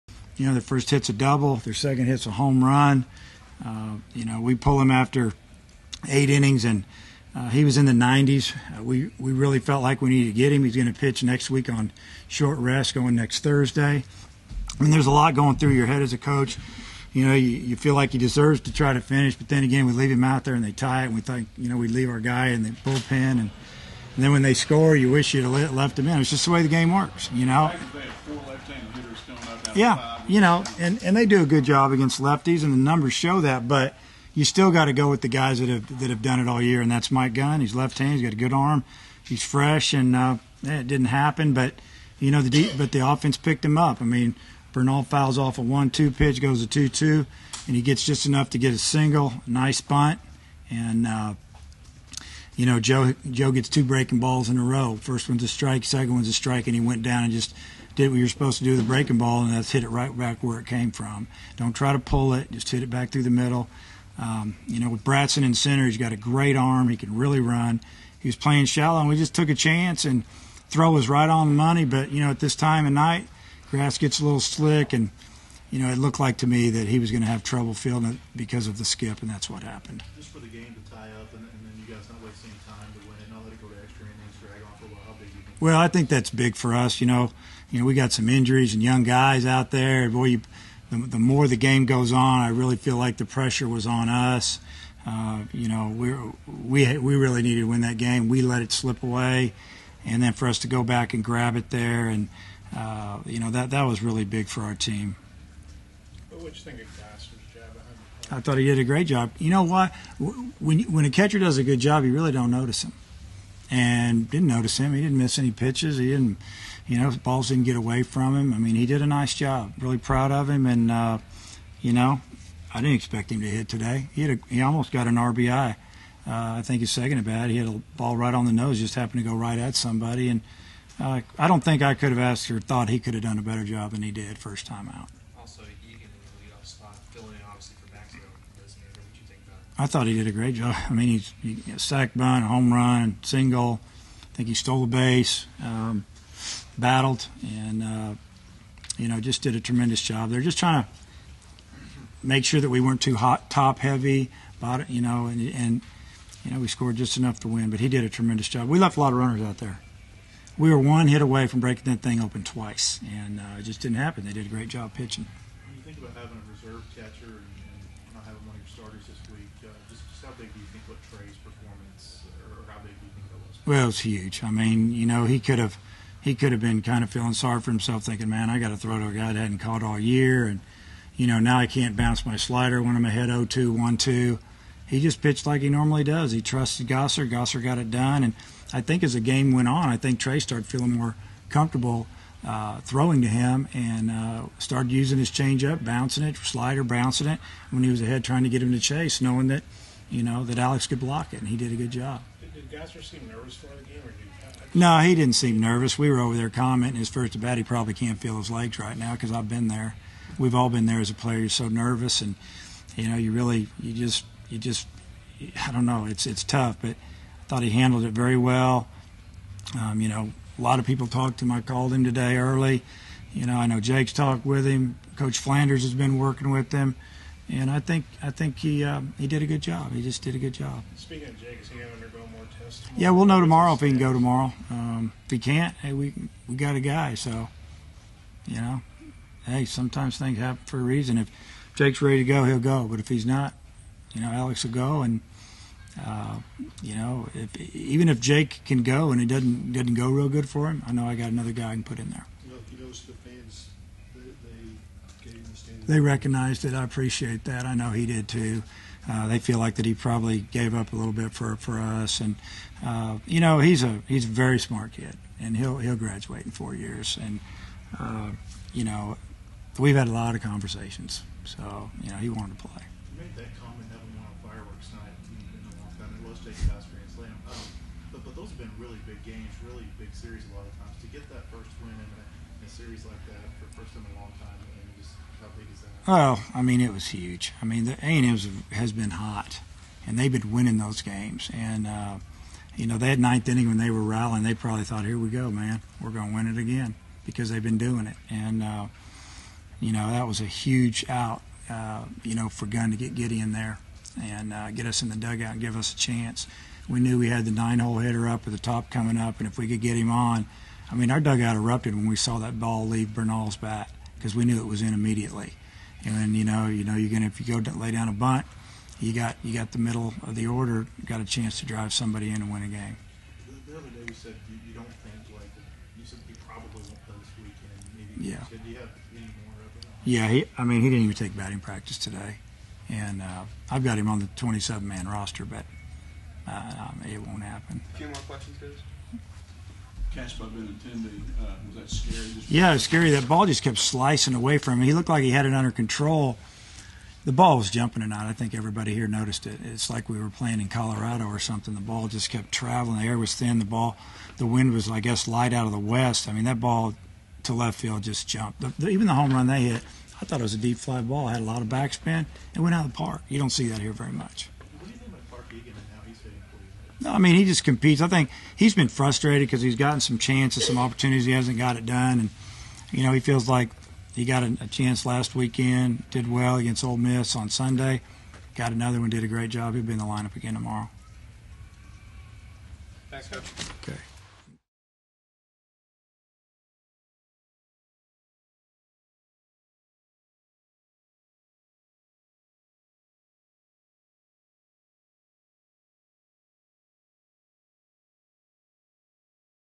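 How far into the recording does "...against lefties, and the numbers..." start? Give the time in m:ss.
0:31.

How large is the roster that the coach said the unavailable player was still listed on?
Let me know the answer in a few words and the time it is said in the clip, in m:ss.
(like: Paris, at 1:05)
27-man roster, at 5:34.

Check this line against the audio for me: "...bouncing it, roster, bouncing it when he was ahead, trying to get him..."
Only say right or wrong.
wrong.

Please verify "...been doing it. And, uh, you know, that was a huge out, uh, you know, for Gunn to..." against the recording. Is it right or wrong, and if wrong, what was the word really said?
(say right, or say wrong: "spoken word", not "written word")
right.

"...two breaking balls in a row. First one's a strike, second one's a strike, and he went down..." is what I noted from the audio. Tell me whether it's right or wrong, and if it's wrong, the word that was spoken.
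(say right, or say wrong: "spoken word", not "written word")
right.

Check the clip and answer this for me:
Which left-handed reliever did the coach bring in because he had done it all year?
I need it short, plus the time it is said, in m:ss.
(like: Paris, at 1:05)
Mike Gunn, at 0:37.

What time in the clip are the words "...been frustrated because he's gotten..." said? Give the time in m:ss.
6:08.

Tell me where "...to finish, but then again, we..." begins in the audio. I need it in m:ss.
0:18.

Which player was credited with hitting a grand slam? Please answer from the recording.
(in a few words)
Jason Dodds.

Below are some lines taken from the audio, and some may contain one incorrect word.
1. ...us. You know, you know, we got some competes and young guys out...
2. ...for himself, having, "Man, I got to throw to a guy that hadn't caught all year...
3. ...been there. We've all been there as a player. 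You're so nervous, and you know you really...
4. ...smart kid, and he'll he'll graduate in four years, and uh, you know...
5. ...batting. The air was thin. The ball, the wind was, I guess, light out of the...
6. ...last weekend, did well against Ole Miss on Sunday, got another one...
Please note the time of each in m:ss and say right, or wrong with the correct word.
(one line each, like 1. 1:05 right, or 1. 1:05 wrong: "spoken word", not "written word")
1. 1:26 wrong: "injuries", not "competes"
2. 2:57 wrong: "thinking", not "having"
3. 3:29 right
4. 4:24 right
5. 5:52 wrong: "traveling", not "batting"
6. 6:15 right.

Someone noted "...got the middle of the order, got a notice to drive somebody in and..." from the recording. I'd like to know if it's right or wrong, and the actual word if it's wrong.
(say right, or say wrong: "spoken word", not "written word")
wrong: "chance", not "notice".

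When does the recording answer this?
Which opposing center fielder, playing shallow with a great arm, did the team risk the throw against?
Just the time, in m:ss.
1:05.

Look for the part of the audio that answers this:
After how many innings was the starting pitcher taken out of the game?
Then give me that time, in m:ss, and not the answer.
0:06.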